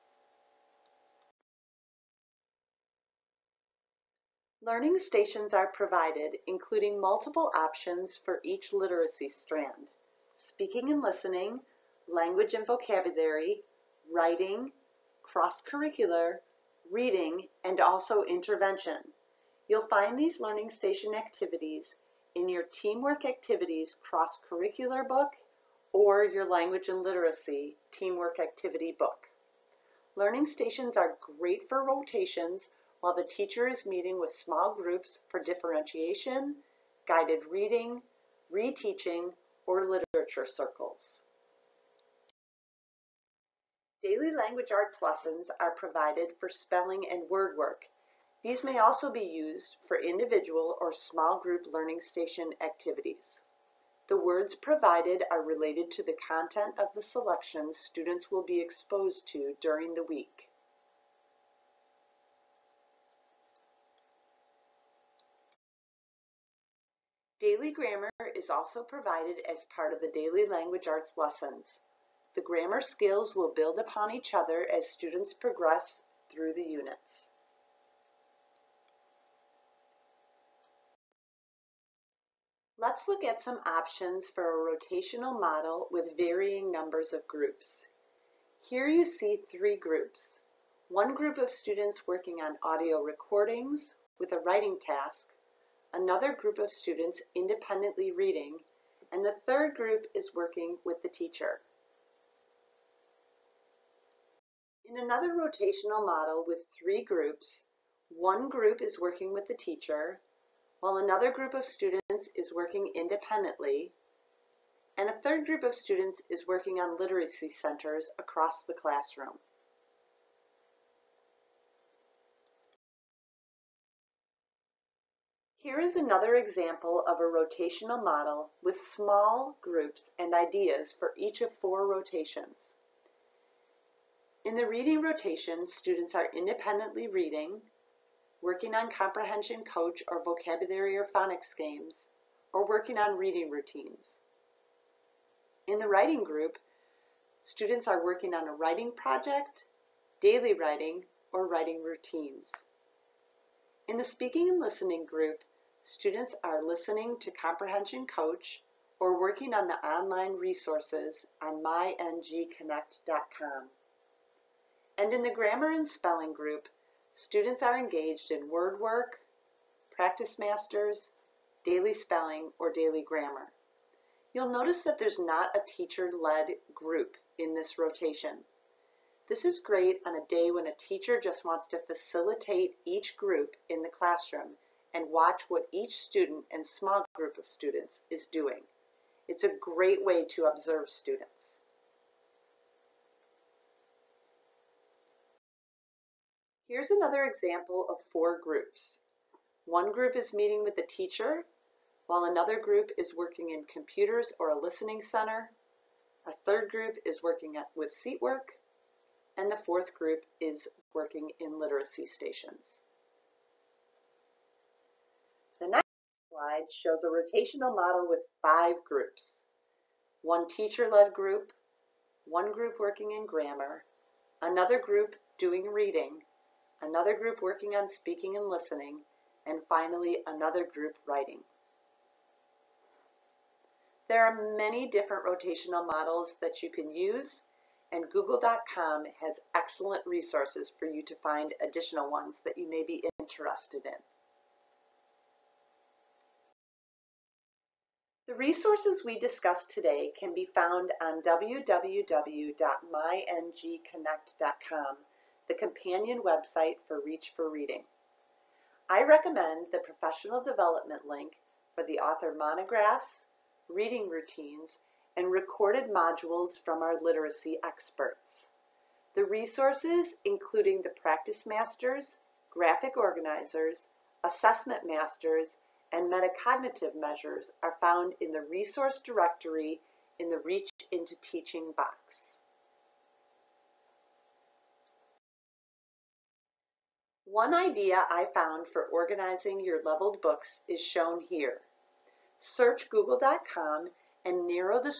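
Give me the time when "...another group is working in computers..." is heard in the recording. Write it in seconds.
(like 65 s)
202 s.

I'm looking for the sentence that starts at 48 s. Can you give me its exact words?
These may also be used for individual or small group learning station activities.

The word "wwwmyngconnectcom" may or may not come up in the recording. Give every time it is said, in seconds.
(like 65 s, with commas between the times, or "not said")
251 s.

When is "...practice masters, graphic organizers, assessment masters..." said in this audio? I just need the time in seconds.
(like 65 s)
270 s.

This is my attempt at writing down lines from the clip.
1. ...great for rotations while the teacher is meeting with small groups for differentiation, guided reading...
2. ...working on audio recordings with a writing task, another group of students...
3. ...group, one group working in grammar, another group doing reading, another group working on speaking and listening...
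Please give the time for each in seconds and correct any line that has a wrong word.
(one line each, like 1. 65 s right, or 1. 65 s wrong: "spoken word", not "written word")
1. 31 s right
2. 92 s right
3. 221 s right.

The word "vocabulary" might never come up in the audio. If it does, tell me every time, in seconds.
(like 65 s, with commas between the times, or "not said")
12 s, 140 s.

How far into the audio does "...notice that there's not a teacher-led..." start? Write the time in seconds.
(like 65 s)
174 s.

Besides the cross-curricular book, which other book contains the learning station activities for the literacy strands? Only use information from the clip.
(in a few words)
Language and Literacy Teamwork Activity book.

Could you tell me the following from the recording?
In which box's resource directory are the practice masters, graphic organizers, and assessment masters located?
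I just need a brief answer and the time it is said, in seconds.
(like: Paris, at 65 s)
Reach into Teaching, at 280 s.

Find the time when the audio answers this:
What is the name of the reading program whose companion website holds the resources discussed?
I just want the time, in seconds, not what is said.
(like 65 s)
257 s.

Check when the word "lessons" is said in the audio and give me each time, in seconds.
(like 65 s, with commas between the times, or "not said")
45 s, 71 s.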